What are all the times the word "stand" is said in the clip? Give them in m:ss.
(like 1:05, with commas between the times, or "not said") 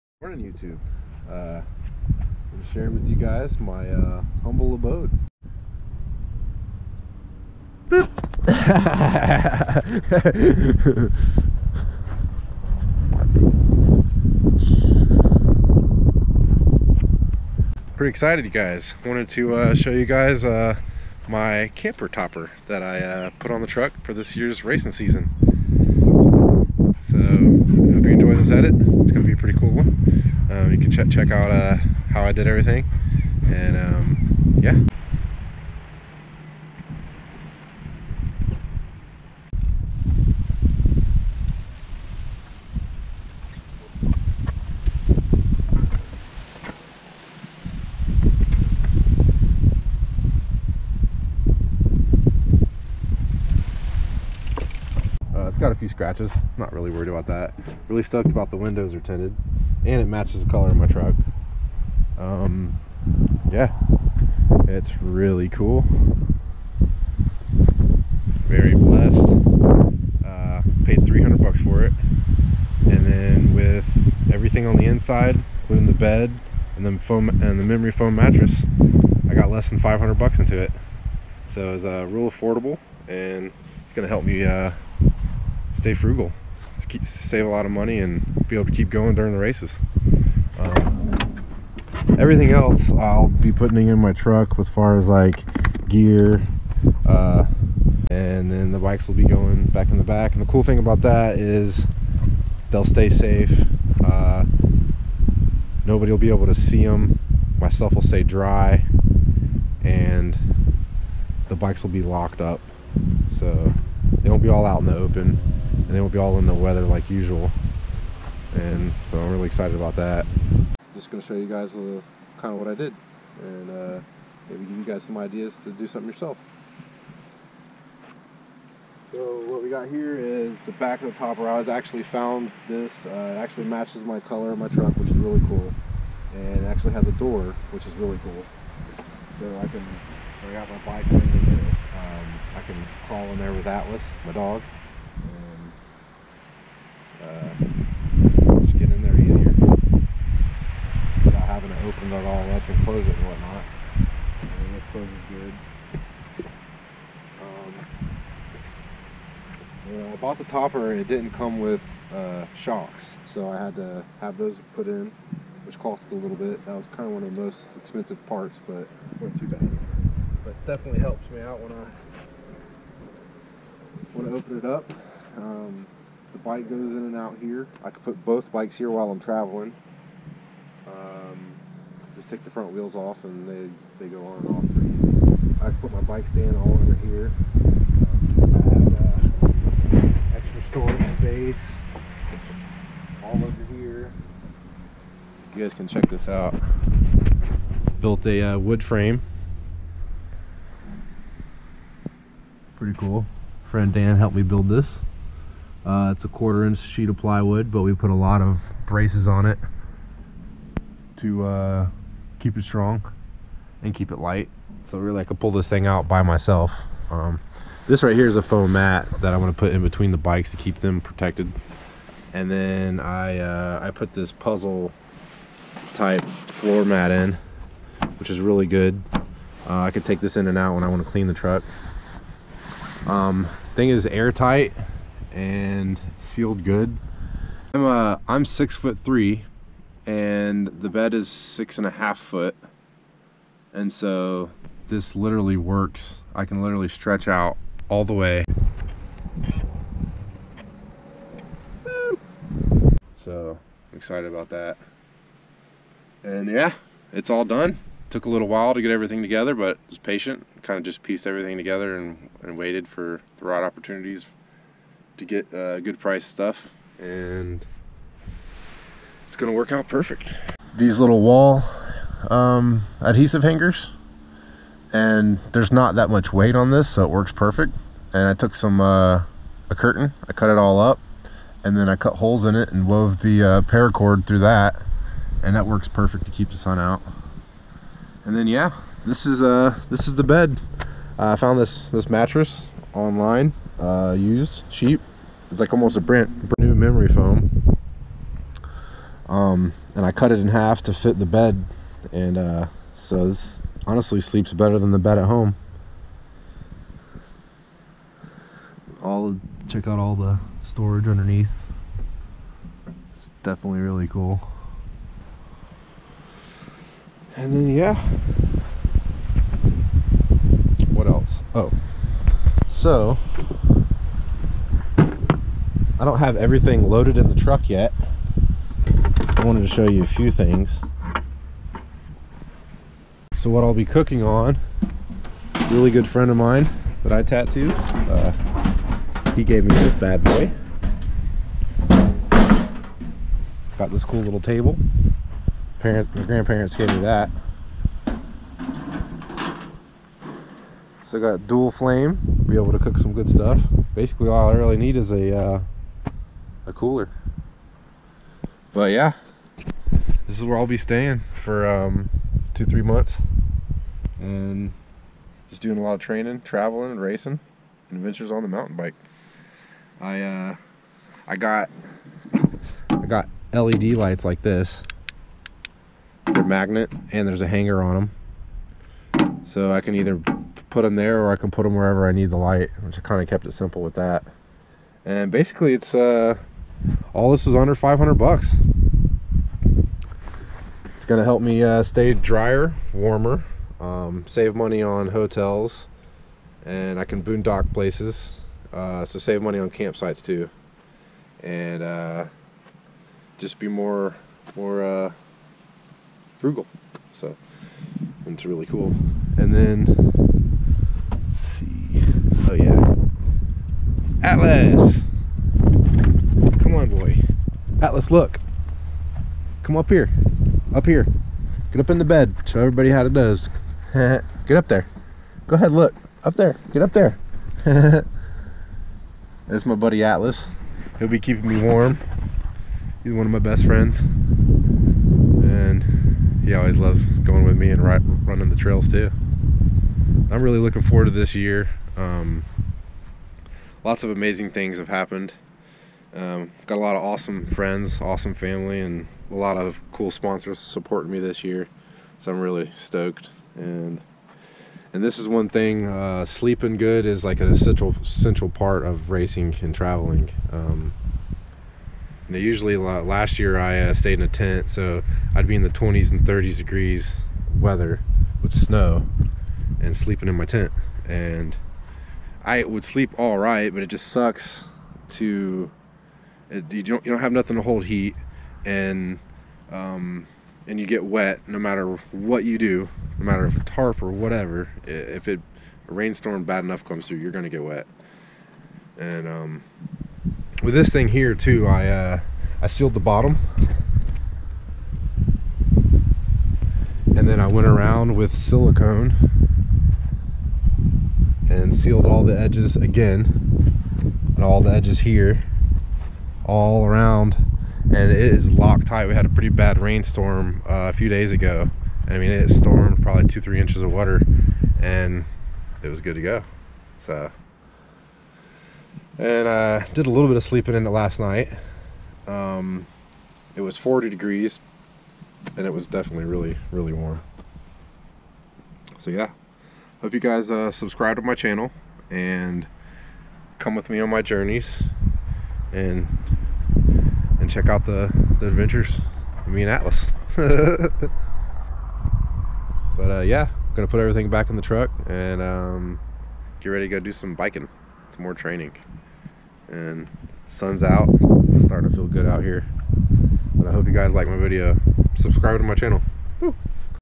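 3:06.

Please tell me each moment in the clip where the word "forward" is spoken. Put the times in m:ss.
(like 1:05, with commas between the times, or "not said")
7:20.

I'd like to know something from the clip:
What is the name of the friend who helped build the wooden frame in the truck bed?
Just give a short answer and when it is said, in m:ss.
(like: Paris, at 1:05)
Dan, at 3:23.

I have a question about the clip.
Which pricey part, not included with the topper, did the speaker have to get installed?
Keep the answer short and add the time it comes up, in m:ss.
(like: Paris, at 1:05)
Shocks, at 2:42.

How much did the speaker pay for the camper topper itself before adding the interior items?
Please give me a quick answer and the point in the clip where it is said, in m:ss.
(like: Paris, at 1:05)
$300, at 1:11.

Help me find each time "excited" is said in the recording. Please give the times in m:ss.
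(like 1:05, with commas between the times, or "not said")
0:18, 1:59, 4:13.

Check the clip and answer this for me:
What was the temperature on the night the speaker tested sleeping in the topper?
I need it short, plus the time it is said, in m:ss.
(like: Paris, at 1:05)
40 degrees, at 8:43.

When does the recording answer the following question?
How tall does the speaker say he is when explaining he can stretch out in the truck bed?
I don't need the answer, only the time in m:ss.
3:58.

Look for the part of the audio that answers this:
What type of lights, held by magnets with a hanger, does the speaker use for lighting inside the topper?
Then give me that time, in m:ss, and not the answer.
6:13.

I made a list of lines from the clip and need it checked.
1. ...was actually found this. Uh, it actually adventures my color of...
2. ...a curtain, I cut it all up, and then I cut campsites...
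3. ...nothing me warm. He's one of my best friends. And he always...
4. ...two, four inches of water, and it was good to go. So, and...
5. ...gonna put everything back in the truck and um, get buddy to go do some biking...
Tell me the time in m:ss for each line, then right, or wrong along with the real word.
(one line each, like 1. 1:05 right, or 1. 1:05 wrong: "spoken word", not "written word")
1. 2:11 wrong: "matches", not "adventures"
2. 4:39 wrong: "holes", not "campsites"
3. 7:11 wrong: "keeping", not "nothing"
4. 8:33 wrong: "three", not "four"
5. 9:03 wrong: "ready", not "buddy".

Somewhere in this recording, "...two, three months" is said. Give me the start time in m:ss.
6:02.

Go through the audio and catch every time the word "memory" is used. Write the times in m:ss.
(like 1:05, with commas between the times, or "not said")
1:17, 4:56.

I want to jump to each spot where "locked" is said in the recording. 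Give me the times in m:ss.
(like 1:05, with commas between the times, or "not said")
1:52, 8:28.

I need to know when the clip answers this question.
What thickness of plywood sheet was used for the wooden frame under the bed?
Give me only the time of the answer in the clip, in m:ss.
3:26.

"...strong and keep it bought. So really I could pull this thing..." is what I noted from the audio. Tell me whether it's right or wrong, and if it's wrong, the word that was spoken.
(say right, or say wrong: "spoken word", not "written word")
wrong: "light", not "bought".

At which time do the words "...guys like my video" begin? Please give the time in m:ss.
9:13.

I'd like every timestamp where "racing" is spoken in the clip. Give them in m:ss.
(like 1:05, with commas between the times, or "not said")
0:24, 6:06, 7:39.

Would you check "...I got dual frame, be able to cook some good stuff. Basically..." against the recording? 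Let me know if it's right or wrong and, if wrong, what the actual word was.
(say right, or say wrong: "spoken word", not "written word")
wrong: "flame", not "frame".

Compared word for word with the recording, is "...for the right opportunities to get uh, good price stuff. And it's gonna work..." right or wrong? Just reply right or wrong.
right.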